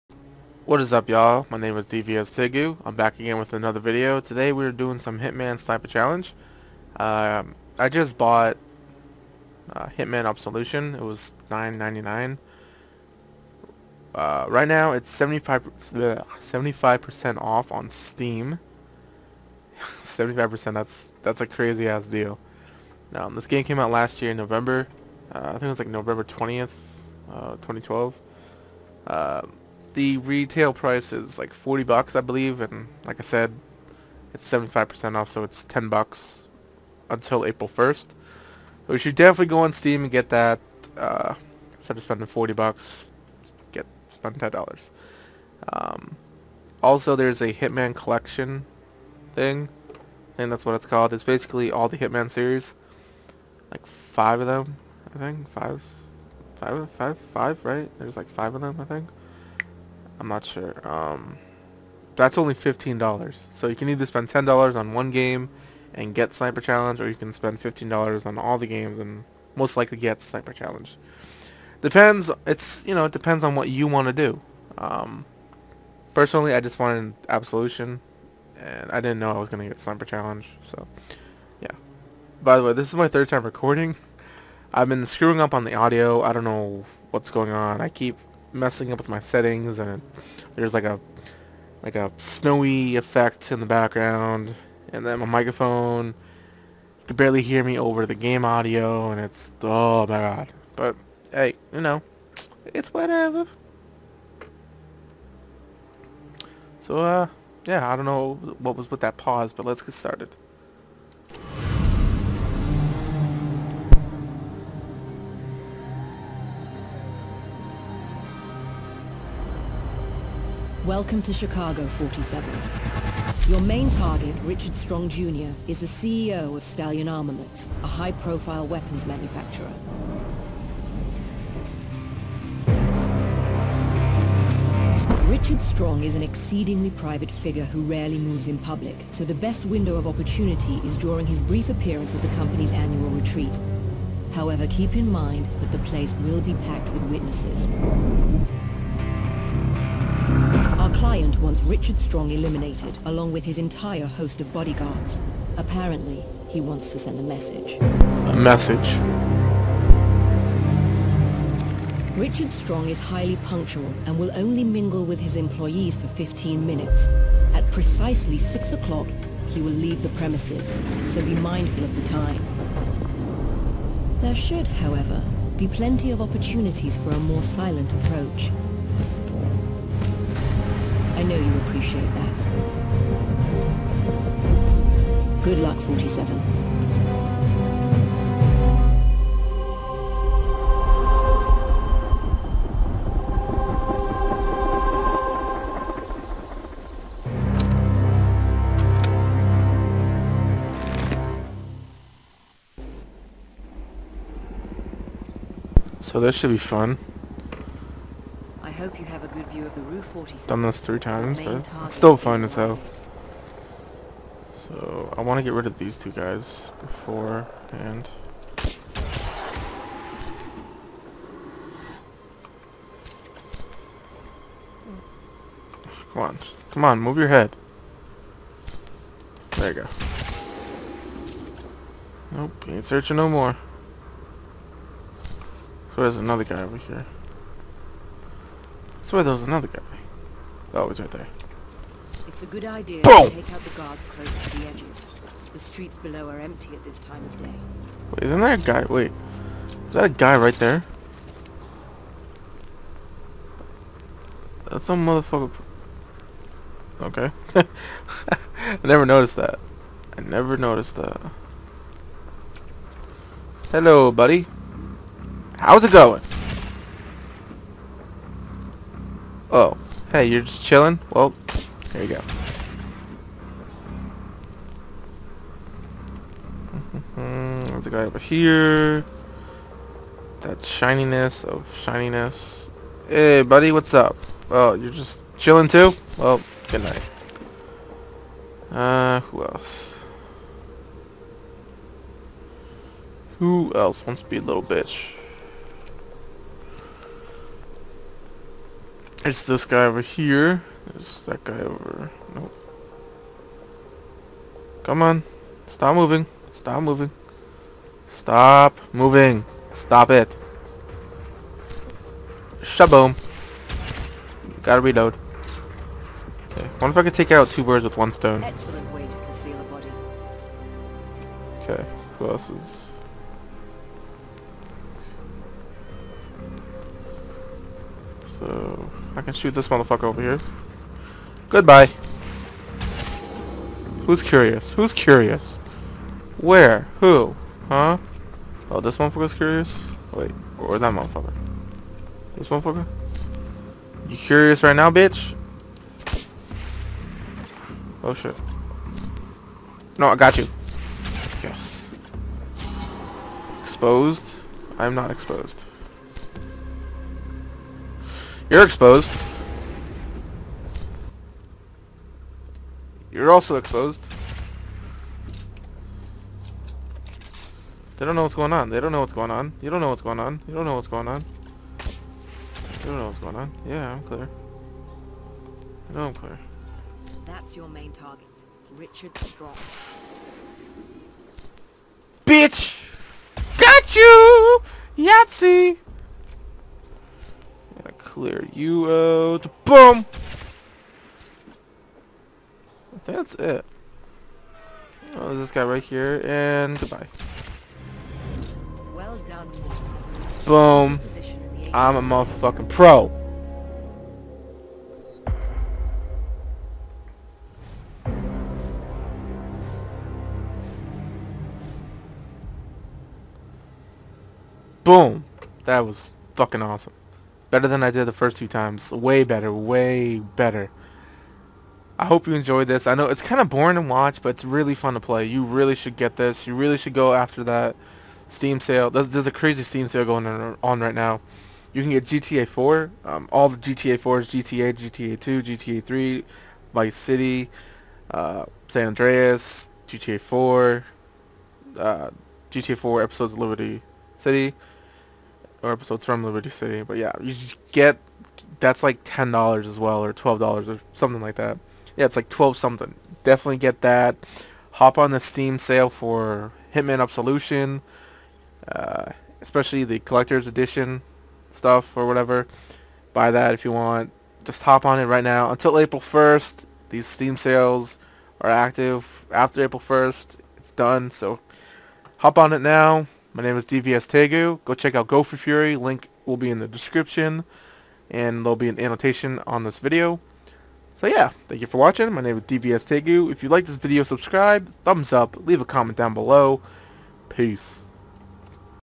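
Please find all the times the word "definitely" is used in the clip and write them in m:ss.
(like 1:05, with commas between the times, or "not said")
0:39, 7:33.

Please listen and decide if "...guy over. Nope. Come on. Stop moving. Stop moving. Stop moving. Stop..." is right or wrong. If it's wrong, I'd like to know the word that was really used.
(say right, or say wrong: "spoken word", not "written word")
right.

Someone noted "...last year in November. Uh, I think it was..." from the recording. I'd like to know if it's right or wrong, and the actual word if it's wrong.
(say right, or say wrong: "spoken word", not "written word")
right.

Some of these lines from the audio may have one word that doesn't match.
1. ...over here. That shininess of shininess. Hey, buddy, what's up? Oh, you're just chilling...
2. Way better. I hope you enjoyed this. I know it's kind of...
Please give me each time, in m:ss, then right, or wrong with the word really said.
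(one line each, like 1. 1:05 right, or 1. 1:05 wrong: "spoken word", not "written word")
1. 4:38 right
2. 6:59 right.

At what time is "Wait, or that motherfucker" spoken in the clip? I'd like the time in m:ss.
5:40.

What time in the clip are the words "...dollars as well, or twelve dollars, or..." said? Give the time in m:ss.
7:29.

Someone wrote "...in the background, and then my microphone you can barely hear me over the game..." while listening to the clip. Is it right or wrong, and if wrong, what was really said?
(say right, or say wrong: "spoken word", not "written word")
right.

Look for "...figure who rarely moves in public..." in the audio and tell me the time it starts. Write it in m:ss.
2:17.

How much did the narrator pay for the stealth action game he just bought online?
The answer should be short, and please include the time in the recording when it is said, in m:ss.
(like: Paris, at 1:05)
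$9.99, at 0:11.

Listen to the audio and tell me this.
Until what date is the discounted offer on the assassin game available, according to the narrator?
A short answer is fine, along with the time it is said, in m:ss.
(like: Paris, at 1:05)
April 1st, at 0:37.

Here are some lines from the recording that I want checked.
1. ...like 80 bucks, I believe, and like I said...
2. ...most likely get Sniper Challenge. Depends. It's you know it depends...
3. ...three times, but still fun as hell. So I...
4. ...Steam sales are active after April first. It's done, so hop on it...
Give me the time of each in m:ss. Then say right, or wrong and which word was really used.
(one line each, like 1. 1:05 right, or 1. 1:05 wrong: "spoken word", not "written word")
1. 0:31 wrong: "40", not "80"
2. 1:09 right
3. 3:30 right
4. 7:47 right.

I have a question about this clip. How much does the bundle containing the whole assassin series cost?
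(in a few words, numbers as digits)
$15.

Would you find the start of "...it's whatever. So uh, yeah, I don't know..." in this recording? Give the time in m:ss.
1:42.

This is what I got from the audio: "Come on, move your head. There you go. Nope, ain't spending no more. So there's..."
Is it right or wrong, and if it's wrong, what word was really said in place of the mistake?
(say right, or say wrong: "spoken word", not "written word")
wrong: "searching", not "spending".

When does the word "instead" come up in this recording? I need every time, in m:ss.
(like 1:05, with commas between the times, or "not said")
0:41.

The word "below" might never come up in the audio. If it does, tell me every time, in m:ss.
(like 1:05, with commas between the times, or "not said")
4:05, 8:06.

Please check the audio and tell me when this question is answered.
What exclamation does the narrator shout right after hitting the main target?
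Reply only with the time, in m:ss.
6:24.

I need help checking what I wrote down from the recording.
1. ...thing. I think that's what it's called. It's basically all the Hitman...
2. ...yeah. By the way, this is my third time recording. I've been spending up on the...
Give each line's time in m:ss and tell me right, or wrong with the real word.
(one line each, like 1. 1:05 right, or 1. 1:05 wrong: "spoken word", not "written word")
1. 0:49 right
2. 1:21 wrong: "screwing", not "spending".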